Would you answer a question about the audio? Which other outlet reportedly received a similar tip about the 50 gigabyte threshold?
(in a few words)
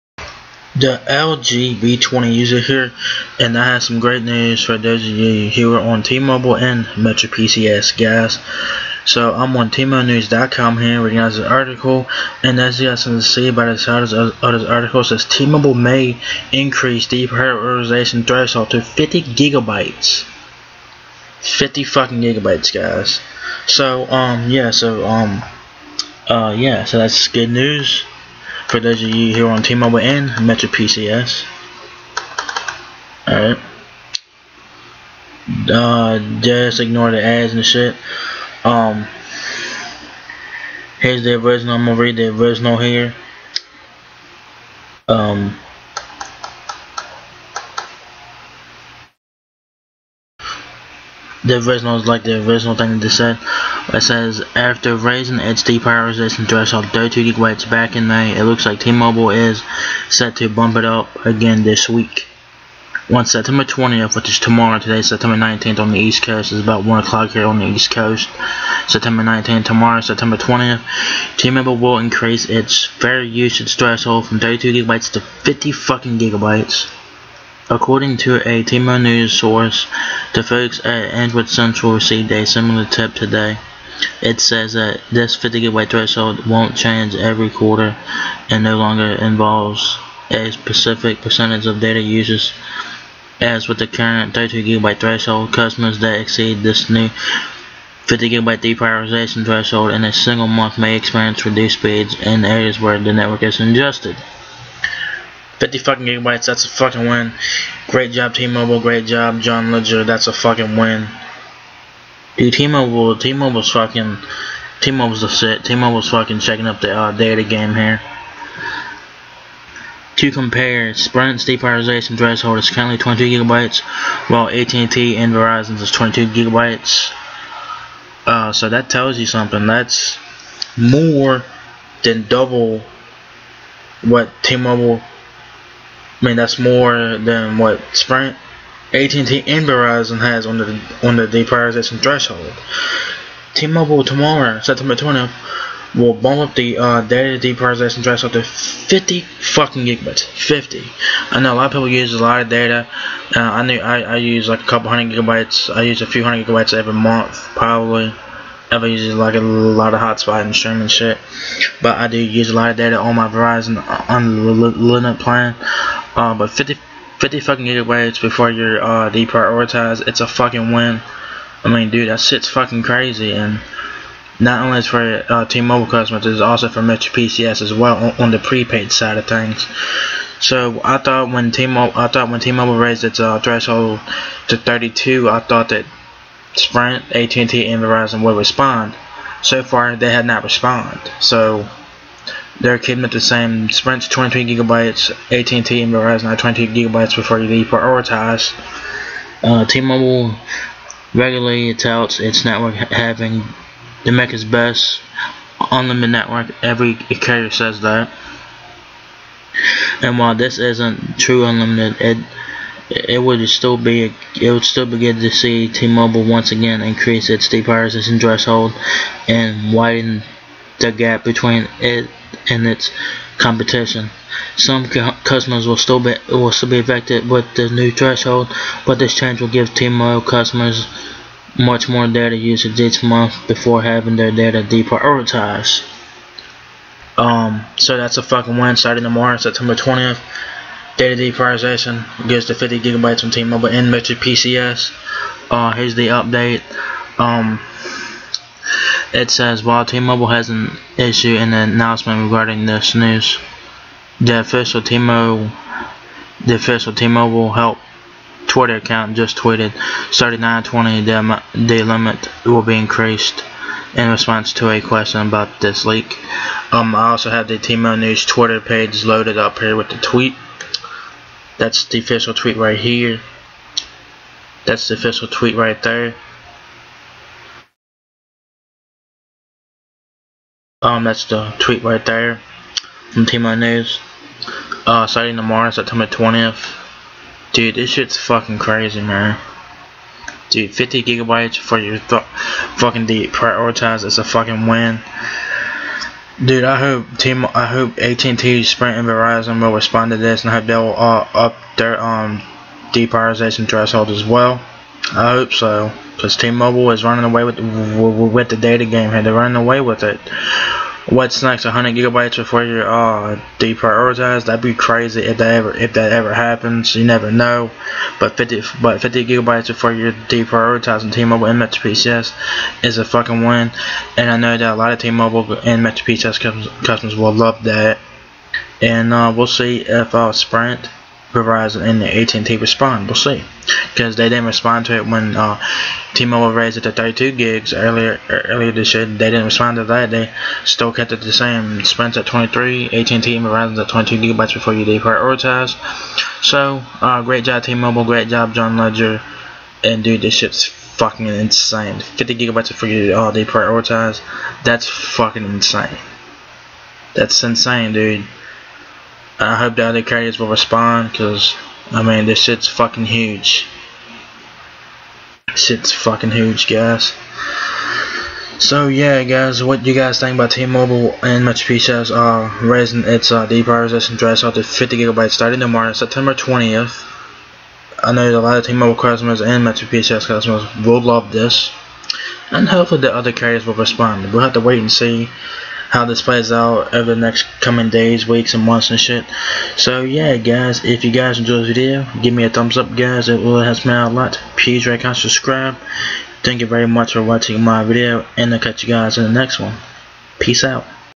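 Android Central.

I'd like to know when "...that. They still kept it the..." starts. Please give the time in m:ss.
5:39.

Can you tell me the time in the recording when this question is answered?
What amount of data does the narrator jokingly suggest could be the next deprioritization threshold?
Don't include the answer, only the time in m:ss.
5:11.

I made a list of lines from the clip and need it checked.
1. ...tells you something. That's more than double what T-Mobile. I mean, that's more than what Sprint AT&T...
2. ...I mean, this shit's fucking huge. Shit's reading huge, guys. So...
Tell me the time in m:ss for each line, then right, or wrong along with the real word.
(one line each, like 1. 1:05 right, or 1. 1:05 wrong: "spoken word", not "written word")
1. 2:08 right
2. 6:01 wrong: "fucking", not "reading".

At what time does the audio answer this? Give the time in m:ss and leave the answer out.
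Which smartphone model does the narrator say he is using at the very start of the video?
0:01.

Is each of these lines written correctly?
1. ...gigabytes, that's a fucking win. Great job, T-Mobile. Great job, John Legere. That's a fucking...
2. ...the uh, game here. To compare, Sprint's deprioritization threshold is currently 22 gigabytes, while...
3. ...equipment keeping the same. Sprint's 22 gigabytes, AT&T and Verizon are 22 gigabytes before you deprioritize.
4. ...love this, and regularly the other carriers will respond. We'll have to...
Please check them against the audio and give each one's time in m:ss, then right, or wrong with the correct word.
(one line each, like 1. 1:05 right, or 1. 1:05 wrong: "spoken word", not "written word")
1. 1:46 right
2. 1:56 right
3. 3:12 right
4. 6:21 wrong: "hopefully", not "regularly".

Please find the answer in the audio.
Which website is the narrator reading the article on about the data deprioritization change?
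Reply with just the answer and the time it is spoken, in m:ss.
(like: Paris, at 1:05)
T-MobileNews.com, at 0:09.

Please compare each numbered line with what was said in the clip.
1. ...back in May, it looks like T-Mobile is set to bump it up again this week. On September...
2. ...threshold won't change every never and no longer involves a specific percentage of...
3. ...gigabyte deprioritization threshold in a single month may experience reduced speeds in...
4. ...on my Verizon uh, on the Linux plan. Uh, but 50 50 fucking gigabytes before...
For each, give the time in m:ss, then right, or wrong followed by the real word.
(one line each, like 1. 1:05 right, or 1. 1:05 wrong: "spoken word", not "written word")
1. 0:57 right
2. 1:25 wrong: "quarter", not "never"
3. 1:38 right
4. 2:42 right.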